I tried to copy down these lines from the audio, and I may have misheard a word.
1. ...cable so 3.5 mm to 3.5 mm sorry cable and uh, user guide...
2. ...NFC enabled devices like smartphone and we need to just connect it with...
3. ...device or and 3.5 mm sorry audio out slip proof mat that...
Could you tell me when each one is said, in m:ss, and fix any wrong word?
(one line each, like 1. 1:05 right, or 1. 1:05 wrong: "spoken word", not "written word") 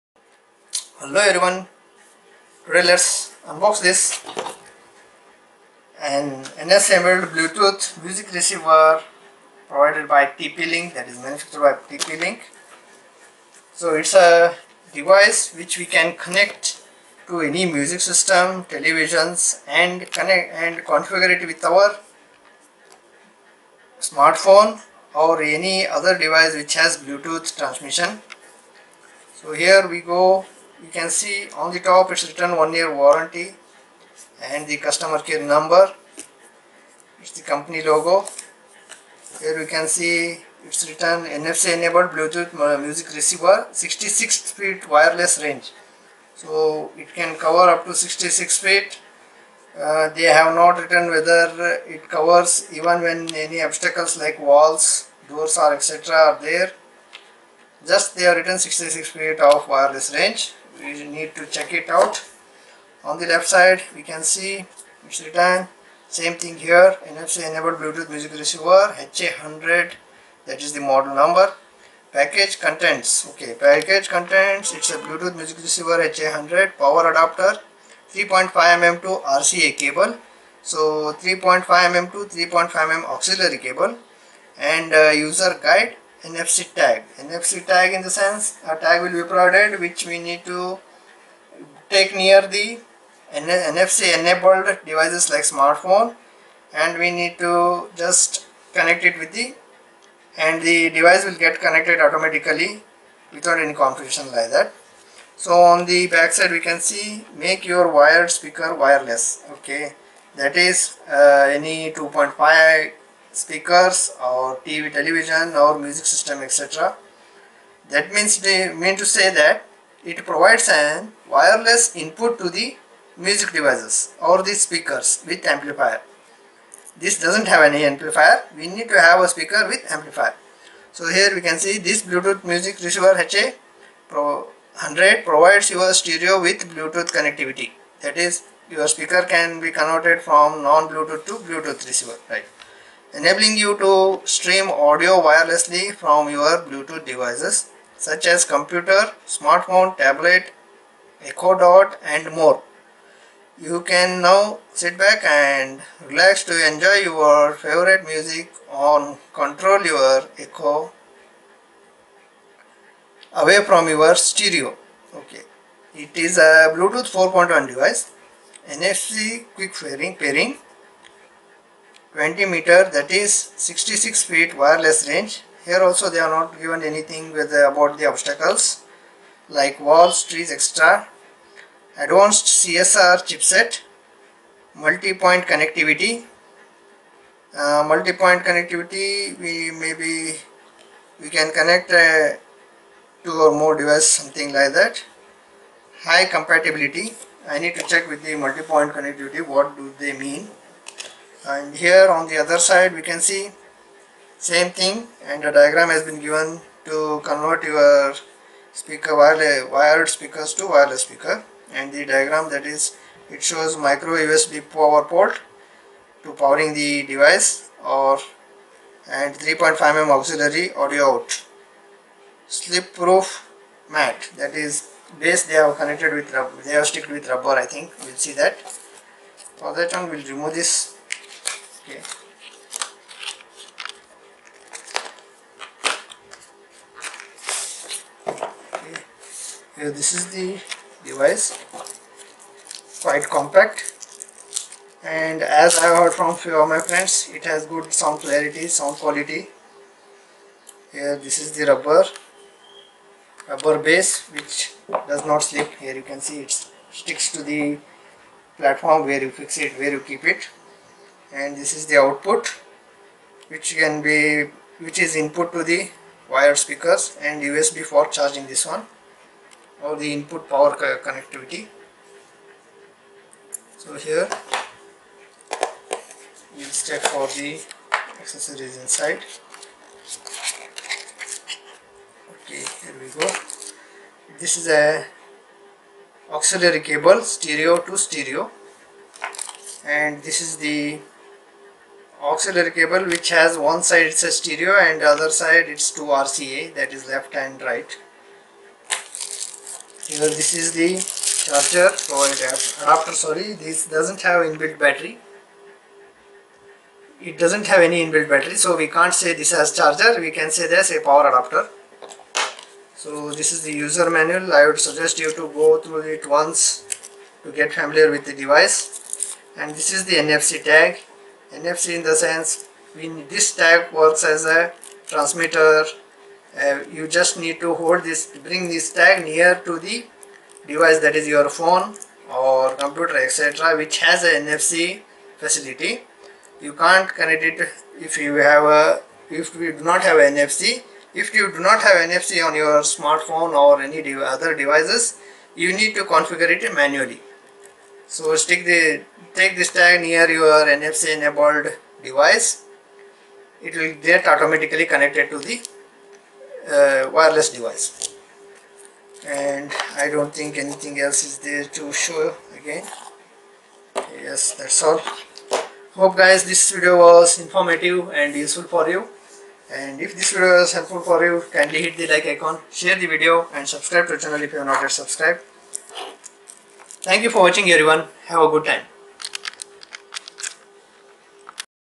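1. 1:19 wrong: "auxiliary", not "sorry"
2. 1:33 right
3. 3:37 wrong: "auxiliary", not "sorry".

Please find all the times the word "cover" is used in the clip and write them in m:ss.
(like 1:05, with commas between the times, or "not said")
0:47, 0:52.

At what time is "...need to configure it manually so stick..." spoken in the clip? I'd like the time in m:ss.
5:45.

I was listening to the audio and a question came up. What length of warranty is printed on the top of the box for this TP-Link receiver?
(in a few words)
1 year.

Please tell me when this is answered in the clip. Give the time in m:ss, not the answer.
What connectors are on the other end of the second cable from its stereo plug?
4:55.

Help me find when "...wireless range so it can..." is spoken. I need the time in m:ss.
0:44.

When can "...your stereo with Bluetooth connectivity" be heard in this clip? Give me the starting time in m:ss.
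2:15.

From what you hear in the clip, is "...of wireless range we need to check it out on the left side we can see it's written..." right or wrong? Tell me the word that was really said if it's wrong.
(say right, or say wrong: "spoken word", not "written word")
right.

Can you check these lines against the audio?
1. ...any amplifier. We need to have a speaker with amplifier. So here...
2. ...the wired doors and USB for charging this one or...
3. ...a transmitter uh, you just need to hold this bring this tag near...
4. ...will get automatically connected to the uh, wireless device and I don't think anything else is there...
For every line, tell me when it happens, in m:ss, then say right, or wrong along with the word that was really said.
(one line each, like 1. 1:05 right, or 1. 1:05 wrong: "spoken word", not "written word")
1. 2:07 right
2. 4:25 wrong: "speakers", not "doors"
3. 5:24 right
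4. 5:53 right.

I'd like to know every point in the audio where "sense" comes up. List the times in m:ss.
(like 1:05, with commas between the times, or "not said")
1:28, 5:22.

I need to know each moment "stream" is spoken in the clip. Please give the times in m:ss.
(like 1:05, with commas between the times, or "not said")
2:24.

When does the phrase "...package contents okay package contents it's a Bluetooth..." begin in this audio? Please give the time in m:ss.
1:12.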